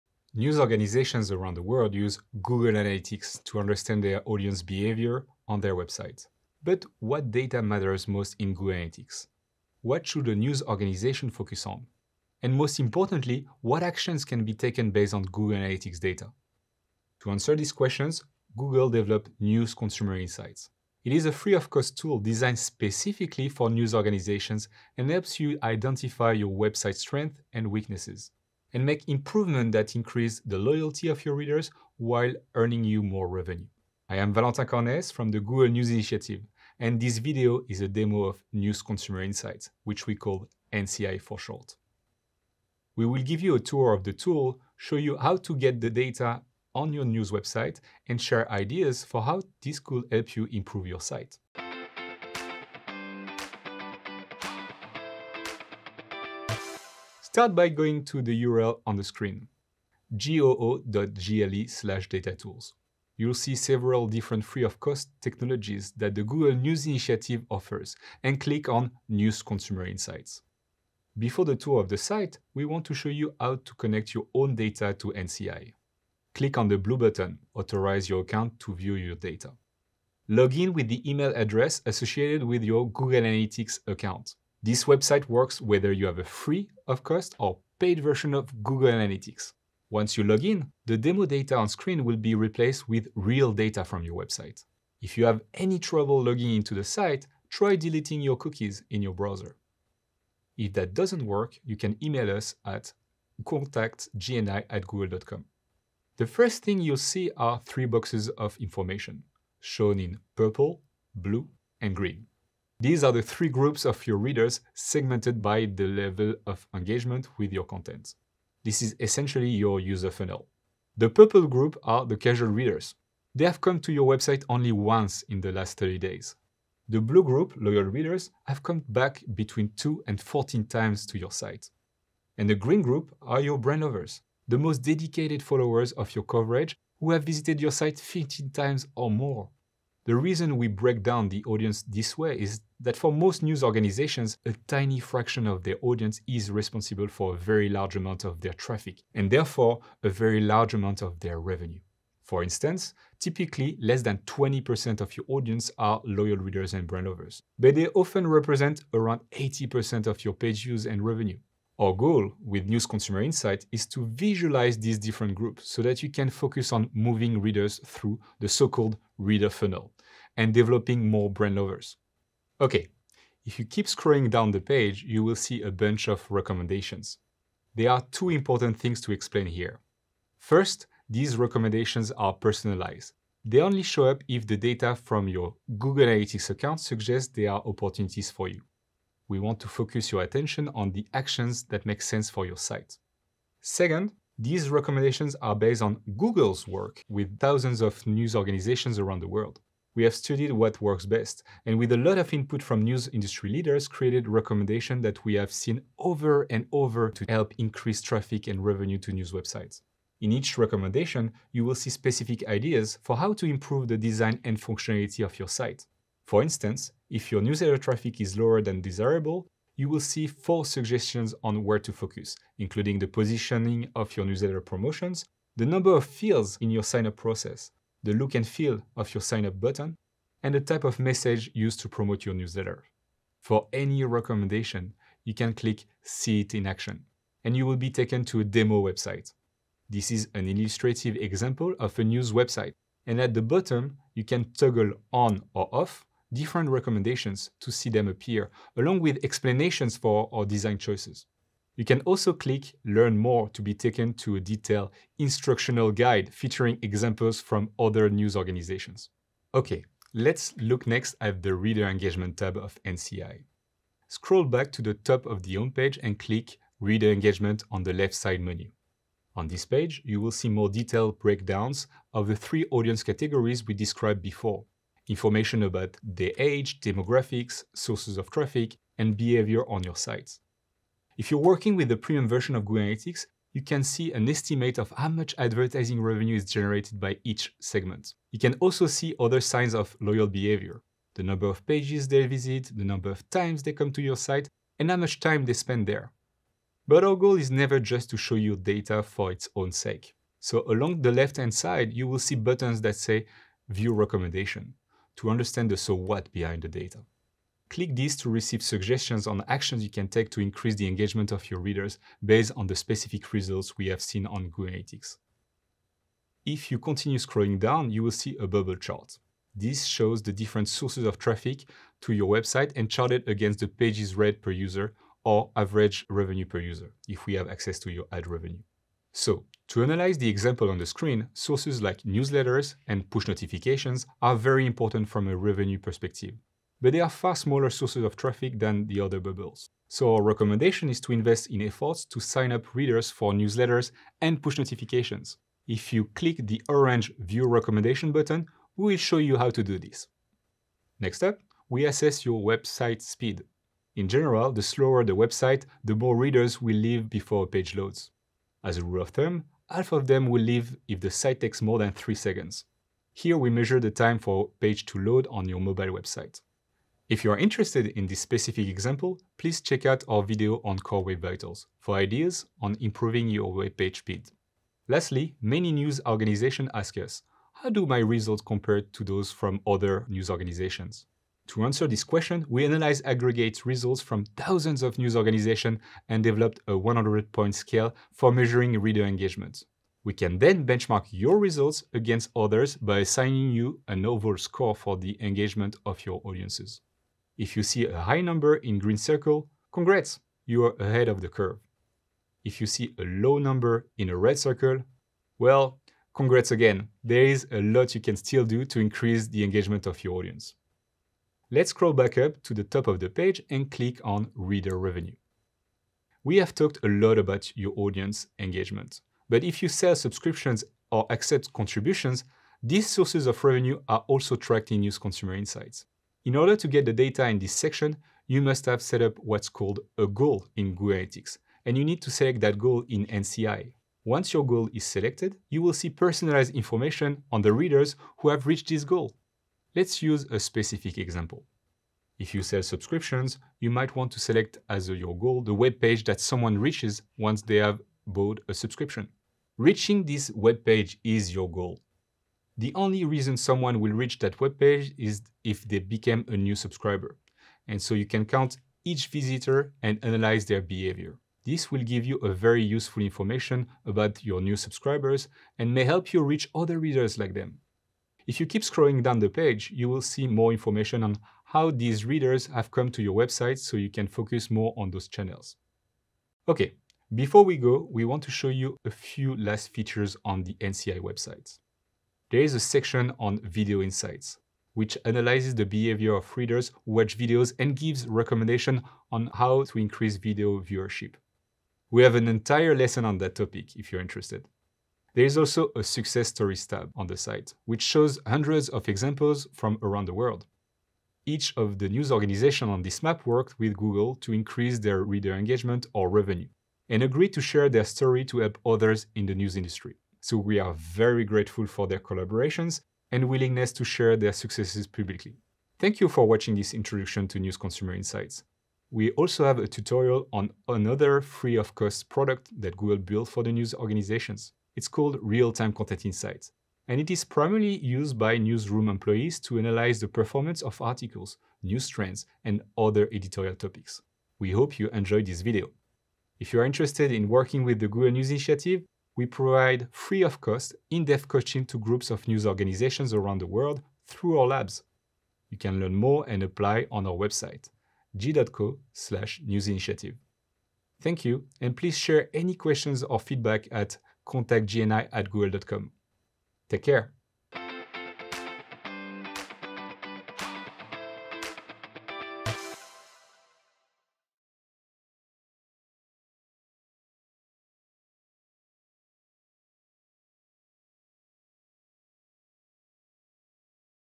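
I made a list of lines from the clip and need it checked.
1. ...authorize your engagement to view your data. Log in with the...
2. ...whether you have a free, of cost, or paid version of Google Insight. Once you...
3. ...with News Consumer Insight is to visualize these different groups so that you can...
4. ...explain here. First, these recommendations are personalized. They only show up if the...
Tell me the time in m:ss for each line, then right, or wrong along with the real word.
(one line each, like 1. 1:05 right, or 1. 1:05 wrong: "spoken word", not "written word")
1. 1:17 wrong: "account", not "engagement"
2. 1:25 wrong: "Analytics", not "Insight"
3. 2:42 right
4. 2:59 right.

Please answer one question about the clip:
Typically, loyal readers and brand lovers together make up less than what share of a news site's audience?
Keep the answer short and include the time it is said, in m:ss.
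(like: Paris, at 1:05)
20%, at 2:34.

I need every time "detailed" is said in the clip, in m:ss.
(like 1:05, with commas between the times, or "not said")
4:14, 4:30.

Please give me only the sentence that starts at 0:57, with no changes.
Start by going to the URL on the screen, goo.gle slash datatools.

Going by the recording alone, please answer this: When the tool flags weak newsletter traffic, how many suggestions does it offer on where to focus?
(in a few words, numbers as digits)
4.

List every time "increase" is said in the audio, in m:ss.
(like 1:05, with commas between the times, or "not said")
0:29, 3:27, 5:10, 6:48, 8:09, 8:24.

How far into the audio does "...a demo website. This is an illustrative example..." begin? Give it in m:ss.
3:58.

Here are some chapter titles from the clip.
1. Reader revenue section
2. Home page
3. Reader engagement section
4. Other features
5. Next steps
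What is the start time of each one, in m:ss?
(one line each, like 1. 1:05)
1. 6:51
2. 0:57
3. 4:19
4. 7:56
5. 8:36.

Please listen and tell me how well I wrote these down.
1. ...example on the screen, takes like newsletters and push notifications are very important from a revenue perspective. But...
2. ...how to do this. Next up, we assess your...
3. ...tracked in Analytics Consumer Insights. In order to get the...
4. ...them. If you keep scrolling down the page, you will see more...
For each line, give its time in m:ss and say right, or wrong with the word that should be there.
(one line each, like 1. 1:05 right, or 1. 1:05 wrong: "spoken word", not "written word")
1. 5:30 wrong: "sources", not "takes"
2. 5:49 right
3. 7:04 wrong: "News", not "Analytics"
4. 7:47 right.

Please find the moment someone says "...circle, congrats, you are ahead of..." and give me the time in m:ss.
6:38.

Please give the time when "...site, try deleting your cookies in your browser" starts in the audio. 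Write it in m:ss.
1:36.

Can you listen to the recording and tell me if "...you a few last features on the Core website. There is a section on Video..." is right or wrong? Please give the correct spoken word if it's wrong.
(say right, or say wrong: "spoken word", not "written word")
wrong: "NCI", not "Core".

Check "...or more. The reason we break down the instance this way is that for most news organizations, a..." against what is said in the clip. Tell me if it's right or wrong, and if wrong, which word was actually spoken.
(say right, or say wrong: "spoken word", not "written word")
wrong: "audience", not "instance".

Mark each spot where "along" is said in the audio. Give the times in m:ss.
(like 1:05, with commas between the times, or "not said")
4:08, 5:00.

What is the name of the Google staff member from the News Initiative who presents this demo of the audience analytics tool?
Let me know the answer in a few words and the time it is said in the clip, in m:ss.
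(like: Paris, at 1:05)
Valentin Cornes, at 0:34.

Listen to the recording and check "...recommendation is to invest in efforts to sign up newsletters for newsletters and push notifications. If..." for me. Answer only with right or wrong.
wrong.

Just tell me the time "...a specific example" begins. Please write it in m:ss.
7:20.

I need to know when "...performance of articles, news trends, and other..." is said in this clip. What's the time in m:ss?
8:50.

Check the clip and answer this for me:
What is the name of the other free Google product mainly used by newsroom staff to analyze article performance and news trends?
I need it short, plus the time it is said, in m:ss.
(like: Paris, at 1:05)
Real-Time Content Insights, at 8:45.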